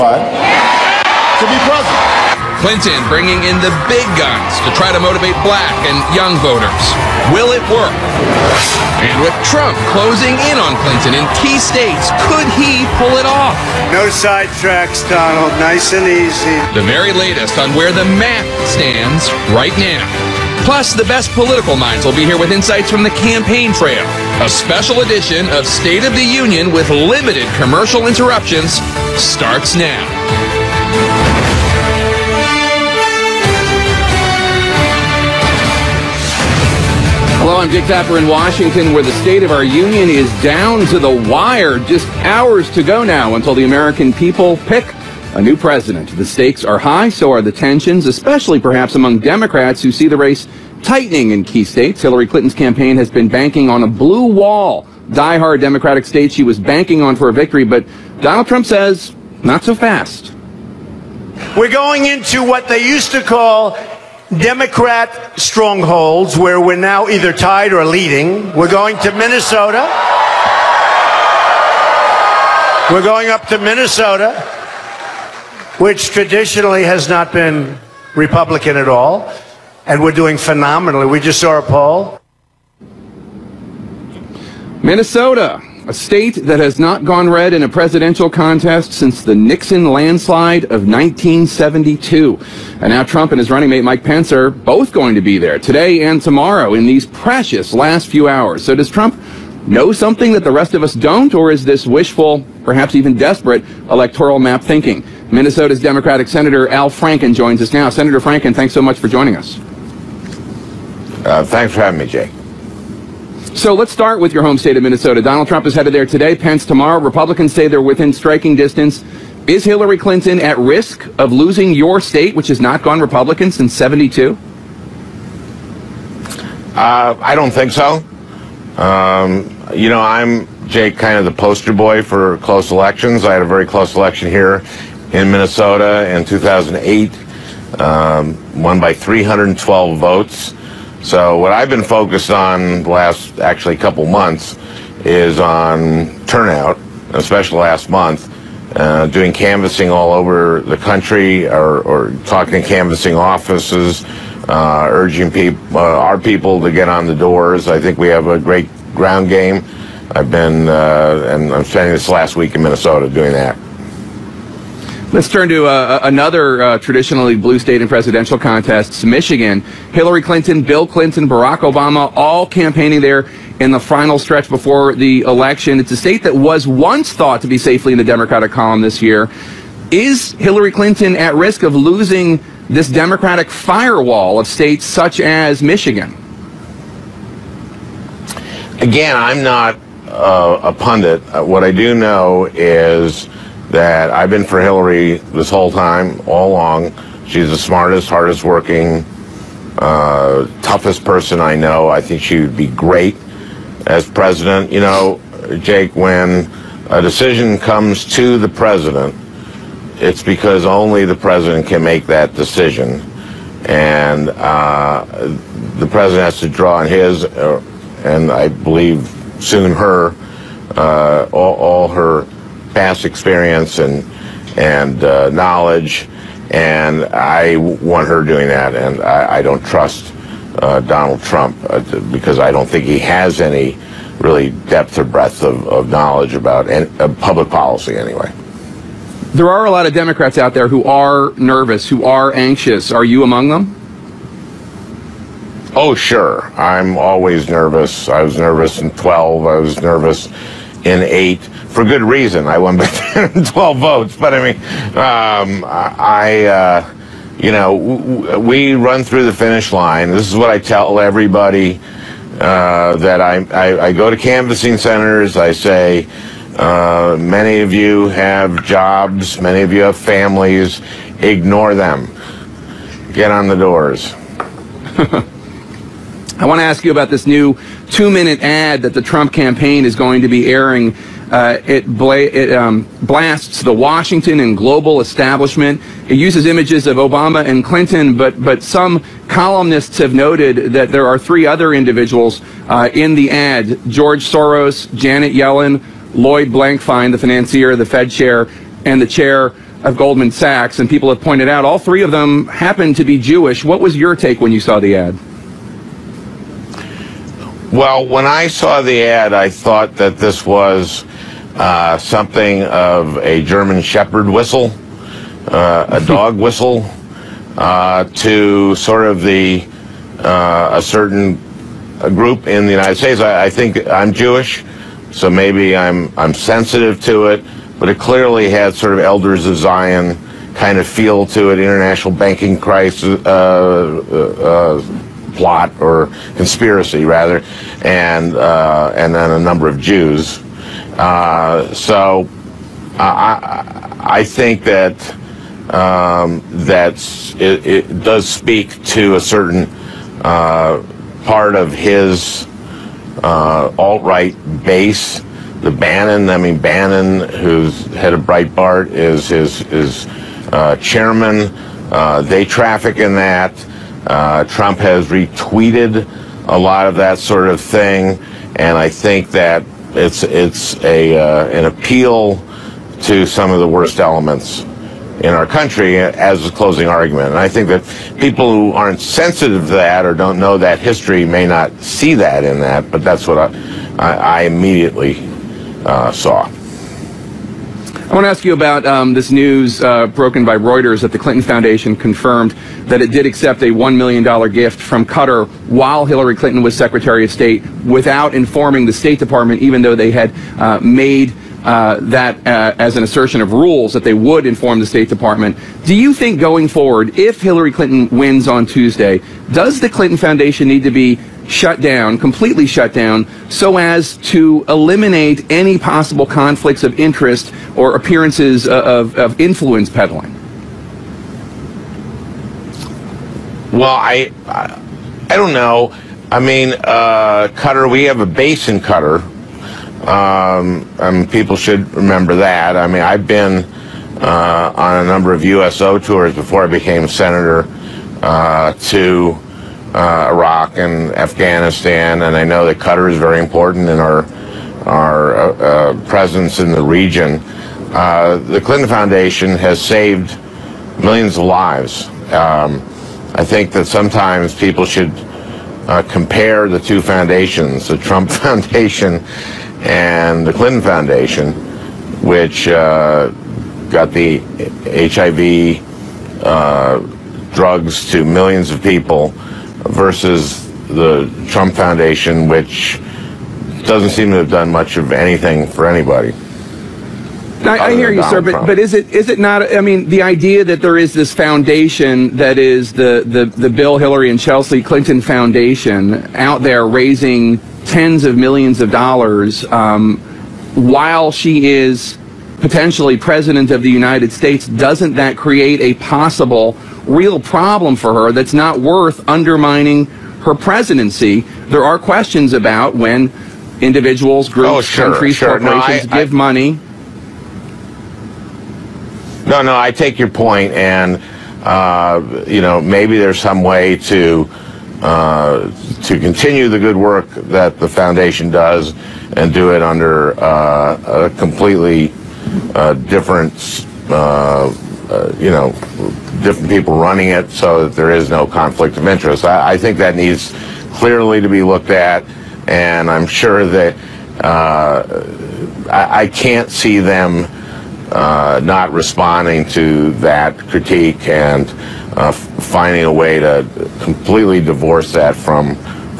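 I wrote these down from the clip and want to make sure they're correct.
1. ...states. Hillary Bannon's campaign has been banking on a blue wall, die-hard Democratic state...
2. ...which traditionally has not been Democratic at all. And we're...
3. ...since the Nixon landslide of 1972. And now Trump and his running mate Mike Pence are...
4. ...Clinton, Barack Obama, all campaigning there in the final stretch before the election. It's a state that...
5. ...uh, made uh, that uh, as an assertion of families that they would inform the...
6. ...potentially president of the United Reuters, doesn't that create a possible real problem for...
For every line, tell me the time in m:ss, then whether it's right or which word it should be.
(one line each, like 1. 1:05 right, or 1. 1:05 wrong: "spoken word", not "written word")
1. 0:51 wrong: "Clinton", not "Bannon"
2. 1:15 wrong: "Republican", not "Democratic"
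3. 1:28 right
4. 2:50 right
5. 6:40 wrong: "rules", not "families"
6. 8:12 wrong: "States", not "Reuters".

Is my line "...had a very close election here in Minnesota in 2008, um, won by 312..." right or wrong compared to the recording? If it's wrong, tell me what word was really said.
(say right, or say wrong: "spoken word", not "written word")
right.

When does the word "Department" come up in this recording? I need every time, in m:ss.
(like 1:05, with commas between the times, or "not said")
6:39, 6:45.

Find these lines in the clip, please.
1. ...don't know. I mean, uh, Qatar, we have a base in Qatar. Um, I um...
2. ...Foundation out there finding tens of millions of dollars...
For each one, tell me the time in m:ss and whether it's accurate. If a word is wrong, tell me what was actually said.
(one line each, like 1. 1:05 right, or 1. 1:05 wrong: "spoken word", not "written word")
1. 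7:05 right
2. 8:05 wrong: "raising", not "finding".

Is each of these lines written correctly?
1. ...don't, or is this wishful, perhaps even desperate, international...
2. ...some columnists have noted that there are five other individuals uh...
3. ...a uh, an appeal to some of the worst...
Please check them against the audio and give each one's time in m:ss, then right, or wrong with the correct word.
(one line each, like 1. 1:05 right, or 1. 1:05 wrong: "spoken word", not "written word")
1. 1:40 wrong: "electoral", not "international"
2. 4:48 wrong: "three", not "five"
3. 6:10 right.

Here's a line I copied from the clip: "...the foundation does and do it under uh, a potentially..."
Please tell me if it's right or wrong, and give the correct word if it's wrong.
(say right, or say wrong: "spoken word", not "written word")
wrong: "completely", not "potentially".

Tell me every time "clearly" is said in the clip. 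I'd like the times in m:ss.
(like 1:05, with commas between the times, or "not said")
5:27, 8:50.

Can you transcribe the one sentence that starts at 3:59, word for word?
There are a lot of Democrats out there who are nervous, who are anxious.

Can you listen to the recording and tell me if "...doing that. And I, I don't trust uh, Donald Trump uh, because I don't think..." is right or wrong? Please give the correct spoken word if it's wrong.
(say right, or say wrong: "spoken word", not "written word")
right.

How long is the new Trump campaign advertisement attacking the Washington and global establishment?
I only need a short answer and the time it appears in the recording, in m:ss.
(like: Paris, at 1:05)
2 minutes, at 4:37.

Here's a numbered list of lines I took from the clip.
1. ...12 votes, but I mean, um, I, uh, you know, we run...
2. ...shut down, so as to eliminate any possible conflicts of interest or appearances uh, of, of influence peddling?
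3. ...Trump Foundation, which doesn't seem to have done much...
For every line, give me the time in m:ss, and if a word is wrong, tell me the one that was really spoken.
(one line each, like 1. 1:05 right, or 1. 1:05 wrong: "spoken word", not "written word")
1. 4:13 right
2. 6:52 right
3. 7:51 right.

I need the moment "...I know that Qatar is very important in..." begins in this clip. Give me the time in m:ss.
7:22.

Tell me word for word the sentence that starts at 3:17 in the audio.
She's the smartest, hardest working, uh, toughest person I know.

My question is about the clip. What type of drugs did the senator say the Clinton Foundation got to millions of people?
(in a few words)
HIV drugs.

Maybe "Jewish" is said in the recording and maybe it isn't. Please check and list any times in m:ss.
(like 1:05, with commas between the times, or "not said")
5:03, 5:24.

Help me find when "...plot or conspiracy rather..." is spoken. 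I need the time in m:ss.
5:35.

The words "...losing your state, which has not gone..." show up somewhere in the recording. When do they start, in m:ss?
2:01.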